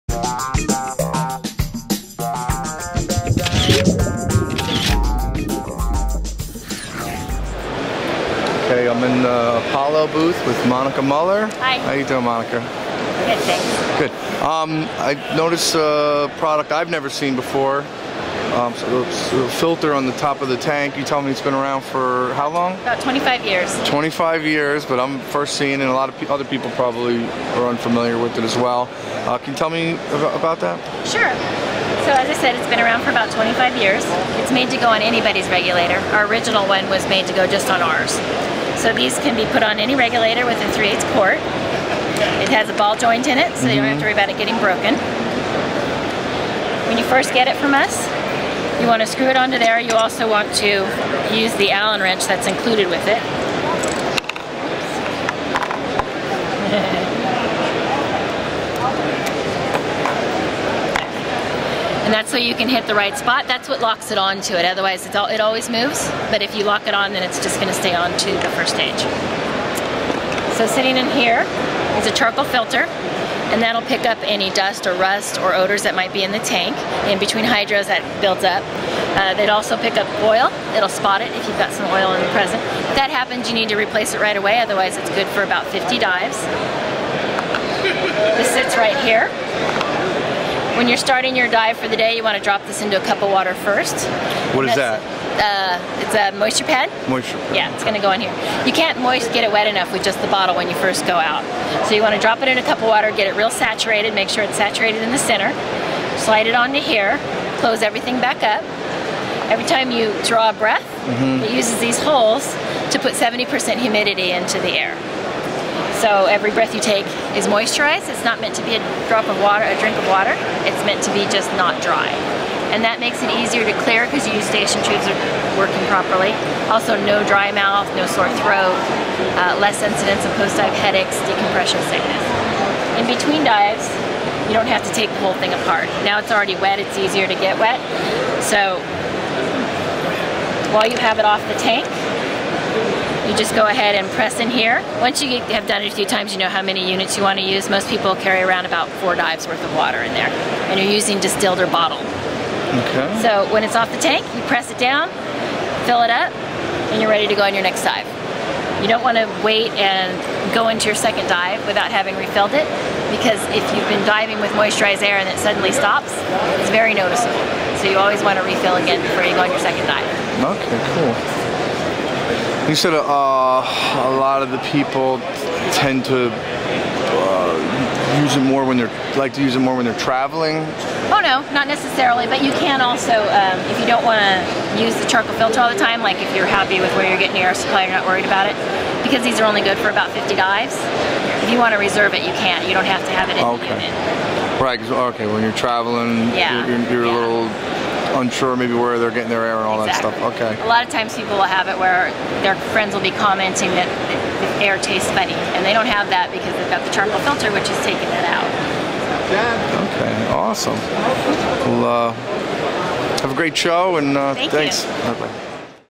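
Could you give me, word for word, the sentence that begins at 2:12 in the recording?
In between dives, you don't have to take the whole thing apart.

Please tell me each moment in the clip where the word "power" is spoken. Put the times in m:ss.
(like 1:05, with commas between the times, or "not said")
not said.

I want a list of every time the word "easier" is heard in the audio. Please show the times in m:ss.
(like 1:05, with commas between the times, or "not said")
2:03, 2:16.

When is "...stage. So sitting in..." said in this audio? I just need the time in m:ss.
1:08.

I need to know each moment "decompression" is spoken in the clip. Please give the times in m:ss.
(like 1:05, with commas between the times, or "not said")
2:11.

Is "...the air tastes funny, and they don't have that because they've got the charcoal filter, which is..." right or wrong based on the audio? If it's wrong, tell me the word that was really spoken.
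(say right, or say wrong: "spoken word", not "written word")
right.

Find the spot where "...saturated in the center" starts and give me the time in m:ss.
1:44.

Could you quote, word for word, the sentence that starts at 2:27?
Most people carry around about four dives worth of water in there.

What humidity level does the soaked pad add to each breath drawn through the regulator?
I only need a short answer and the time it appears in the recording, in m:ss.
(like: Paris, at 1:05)
70%, at 1:53.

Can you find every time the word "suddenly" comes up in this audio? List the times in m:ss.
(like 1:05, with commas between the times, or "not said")
2:45.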